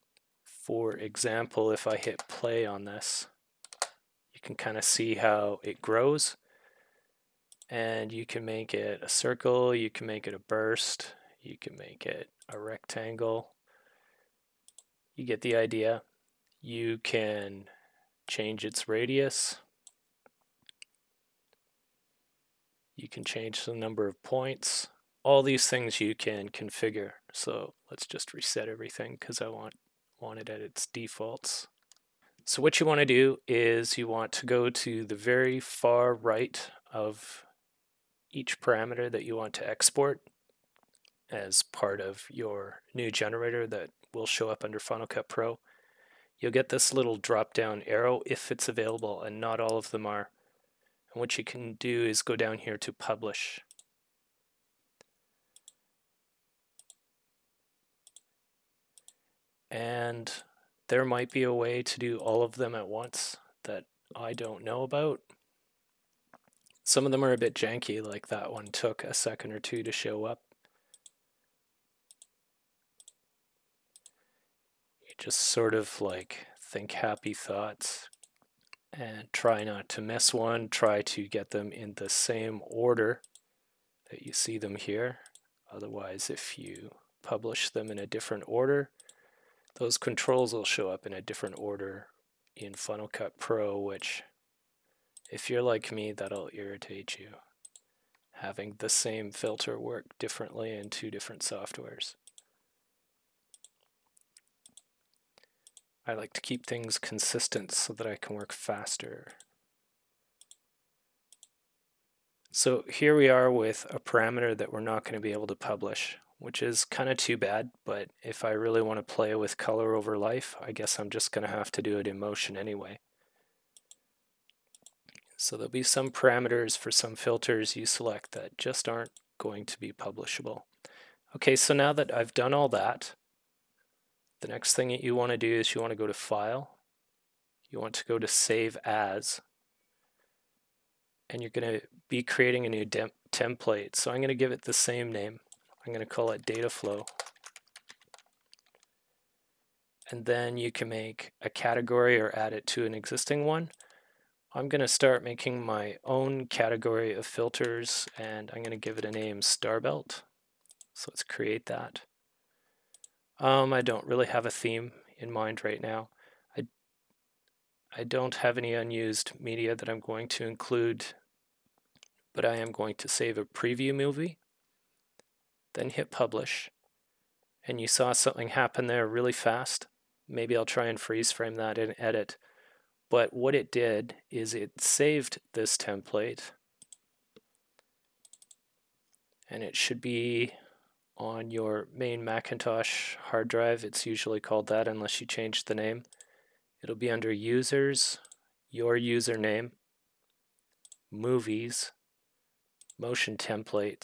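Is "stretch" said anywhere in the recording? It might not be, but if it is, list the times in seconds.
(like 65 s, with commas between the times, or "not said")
not said.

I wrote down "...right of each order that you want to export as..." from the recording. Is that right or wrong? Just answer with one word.
wrong.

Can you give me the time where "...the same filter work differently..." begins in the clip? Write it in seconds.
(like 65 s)
98 s.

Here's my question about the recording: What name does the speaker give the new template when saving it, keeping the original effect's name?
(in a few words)
Data flow.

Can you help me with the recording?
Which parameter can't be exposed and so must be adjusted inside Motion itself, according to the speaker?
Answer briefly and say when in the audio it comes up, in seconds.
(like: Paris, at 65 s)
Color over life, at 119 s.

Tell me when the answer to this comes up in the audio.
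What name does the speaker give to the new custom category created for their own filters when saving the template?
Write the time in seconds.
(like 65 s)
159 s.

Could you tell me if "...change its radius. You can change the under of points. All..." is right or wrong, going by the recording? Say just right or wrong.
wrong.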